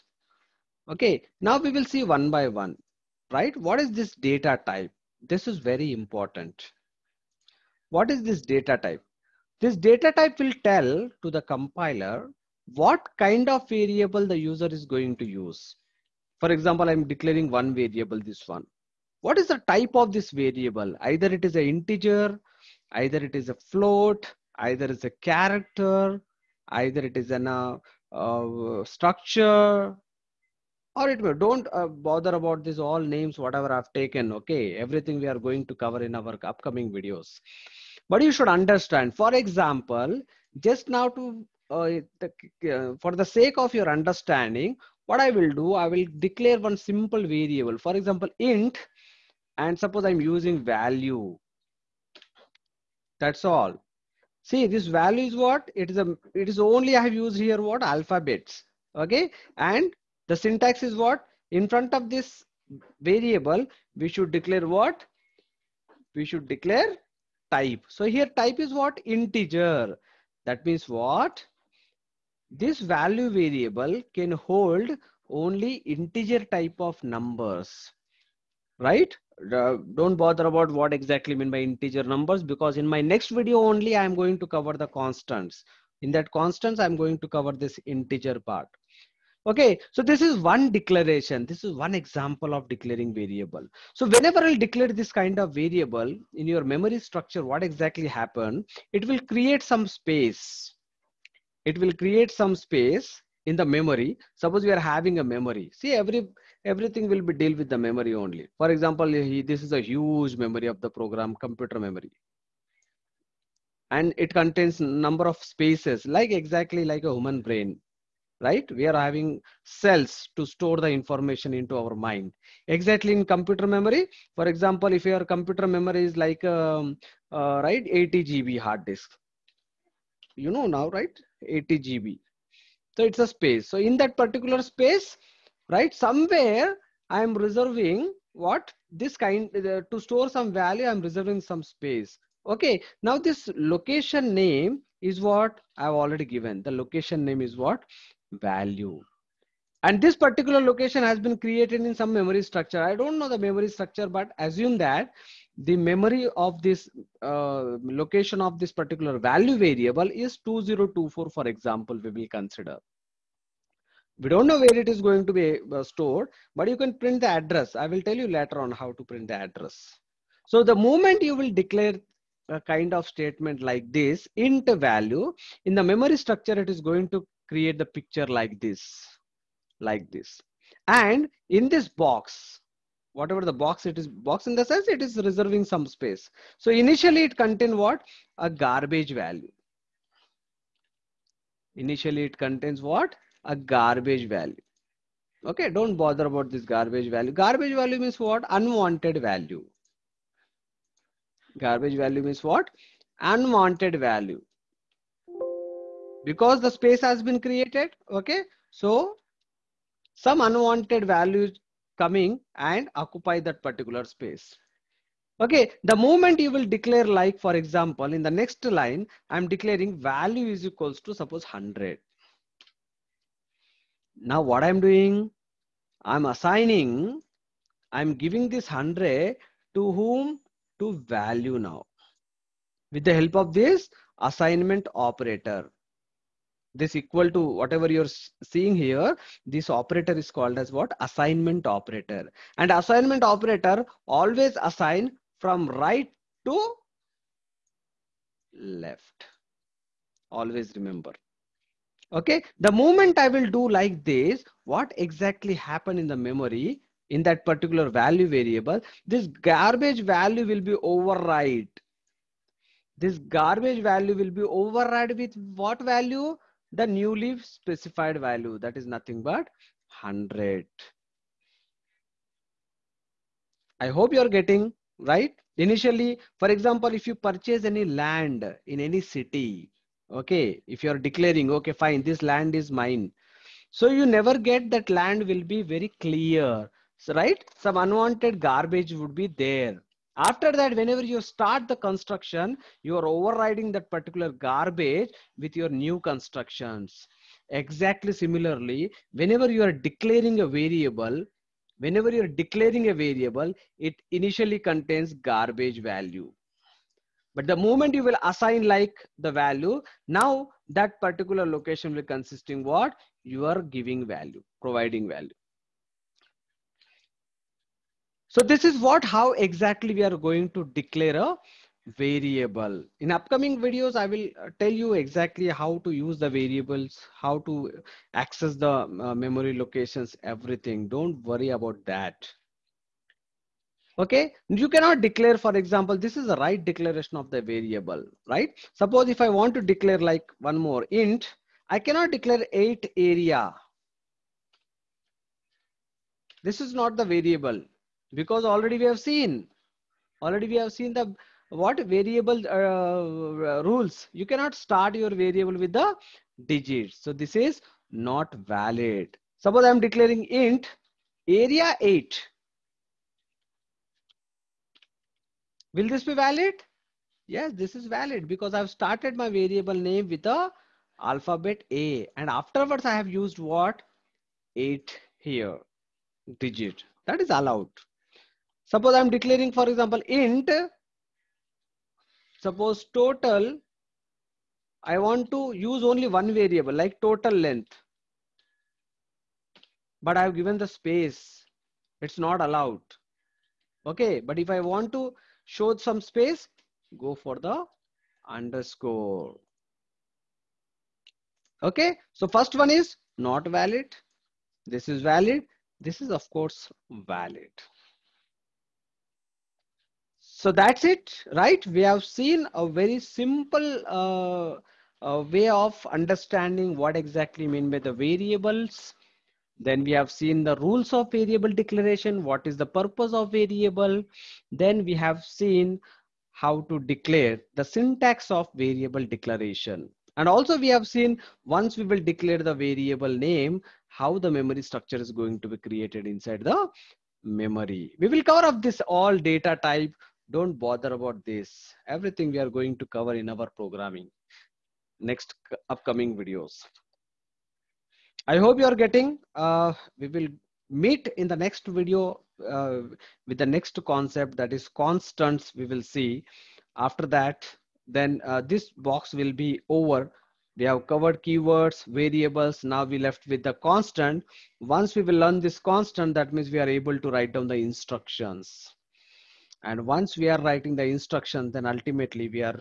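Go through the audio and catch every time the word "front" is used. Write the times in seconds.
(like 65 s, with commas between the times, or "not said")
61 s.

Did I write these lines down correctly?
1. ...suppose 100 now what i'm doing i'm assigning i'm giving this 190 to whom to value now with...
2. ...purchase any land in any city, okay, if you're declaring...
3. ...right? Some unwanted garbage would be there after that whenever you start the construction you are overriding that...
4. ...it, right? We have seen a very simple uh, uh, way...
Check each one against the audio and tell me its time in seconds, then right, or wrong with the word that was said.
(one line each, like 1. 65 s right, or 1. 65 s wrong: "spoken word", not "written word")
1. 221 s wrong: "100", not "190"
2. 277 s right
3. 287 s right
4. 410 s right.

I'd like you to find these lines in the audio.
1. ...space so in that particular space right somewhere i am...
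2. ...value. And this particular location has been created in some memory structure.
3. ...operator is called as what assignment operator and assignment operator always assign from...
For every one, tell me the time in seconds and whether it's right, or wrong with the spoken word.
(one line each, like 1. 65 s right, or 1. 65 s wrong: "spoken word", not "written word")
1. 133 s right
2. 148 s right
3. 239 s right.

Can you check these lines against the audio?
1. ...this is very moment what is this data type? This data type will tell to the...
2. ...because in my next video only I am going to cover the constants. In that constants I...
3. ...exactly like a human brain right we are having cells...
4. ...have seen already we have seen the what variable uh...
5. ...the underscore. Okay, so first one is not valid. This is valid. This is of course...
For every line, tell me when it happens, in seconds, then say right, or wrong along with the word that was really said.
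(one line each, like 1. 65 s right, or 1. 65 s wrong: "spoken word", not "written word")
1. 5 s wrong: "important", not "moment"
2. 82 s right
3. 116 s right
4. 348 s right
5. 397 s right.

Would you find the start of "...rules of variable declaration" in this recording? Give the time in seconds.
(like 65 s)
420 s.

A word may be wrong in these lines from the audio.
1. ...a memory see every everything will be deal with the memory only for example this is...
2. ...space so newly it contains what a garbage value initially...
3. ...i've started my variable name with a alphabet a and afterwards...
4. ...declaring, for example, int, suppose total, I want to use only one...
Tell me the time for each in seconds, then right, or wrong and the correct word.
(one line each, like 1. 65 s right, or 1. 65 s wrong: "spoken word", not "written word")
1. 105 s right
2. 185 s wrong: "initially", not "newly"
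3. 368 s right
4. 379 s right.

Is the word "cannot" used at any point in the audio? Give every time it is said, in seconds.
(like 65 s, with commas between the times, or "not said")
334 s, 341 s, 354 s.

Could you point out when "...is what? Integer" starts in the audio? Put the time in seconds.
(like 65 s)
68 s.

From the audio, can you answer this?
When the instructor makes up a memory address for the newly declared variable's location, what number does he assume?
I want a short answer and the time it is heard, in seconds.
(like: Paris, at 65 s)
2024, at 160 s.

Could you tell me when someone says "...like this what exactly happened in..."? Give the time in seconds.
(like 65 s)
253 s.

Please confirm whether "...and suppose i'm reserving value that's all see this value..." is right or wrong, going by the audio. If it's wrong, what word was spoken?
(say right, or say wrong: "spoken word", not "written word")
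wrong: "using", not "reserving".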